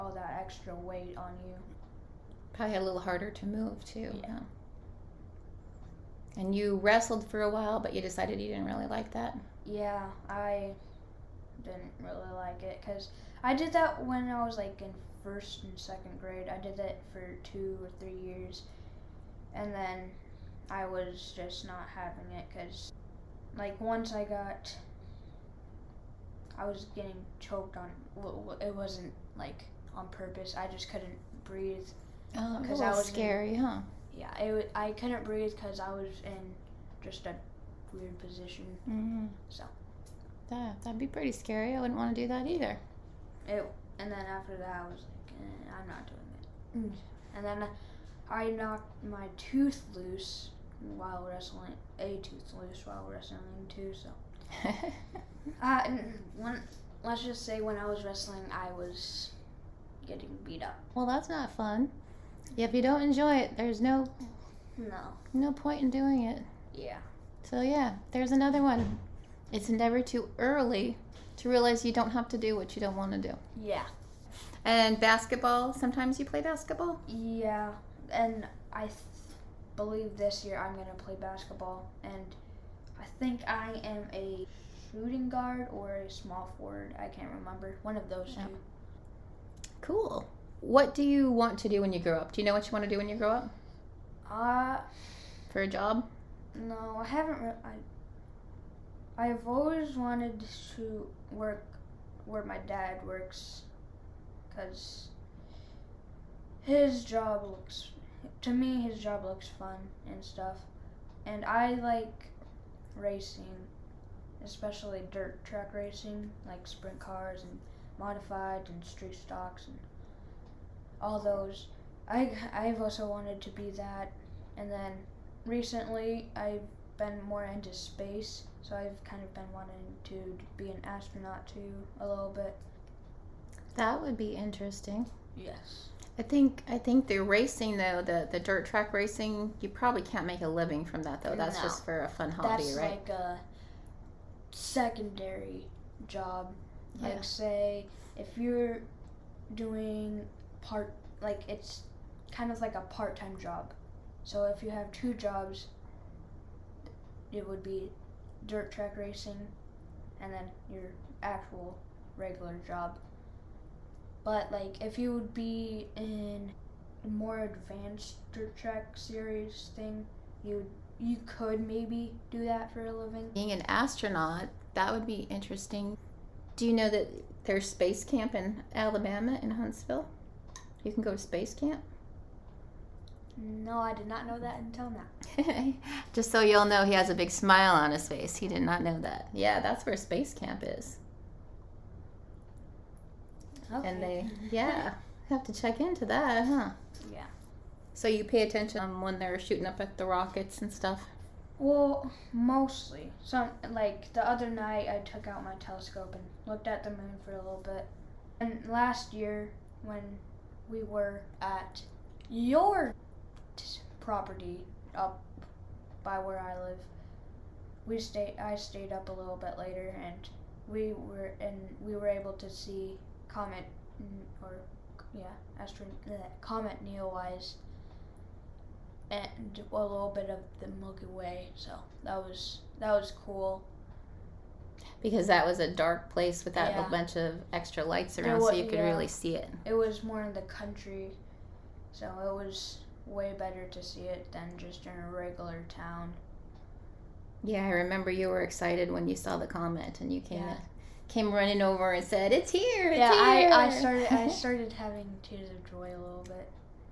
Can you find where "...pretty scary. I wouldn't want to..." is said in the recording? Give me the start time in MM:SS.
00:41.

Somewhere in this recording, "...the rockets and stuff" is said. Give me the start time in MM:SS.
03:19.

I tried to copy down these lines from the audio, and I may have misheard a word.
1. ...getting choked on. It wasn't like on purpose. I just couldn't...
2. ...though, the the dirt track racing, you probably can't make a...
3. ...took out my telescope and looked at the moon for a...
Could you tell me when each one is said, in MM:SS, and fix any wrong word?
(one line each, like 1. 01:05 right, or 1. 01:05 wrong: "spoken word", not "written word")
1. 00:26 right
2. 02:17 right
3. 03:24 right.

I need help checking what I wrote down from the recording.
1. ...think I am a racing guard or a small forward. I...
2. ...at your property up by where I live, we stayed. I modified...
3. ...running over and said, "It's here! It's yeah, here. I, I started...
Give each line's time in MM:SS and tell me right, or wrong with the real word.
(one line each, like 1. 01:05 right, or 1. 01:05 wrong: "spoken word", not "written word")
1. 01:23 wrong: "shooting", not "racing"
2. 03:31 wrong: "stayed", not "modified"
3. 04:11 right.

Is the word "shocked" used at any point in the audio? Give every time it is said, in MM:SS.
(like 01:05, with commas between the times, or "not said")
not said.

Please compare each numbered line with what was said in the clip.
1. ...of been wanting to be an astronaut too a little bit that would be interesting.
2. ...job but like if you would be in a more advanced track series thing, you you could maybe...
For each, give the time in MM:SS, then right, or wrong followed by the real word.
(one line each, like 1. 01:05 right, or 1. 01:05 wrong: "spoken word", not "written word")
1. 02:09 right
2. 02:42 right.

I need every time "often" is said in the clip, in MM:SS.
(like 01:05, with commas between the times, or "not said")
not said.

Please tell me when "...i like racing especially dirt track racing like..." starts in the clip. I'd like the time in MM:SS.
01:51.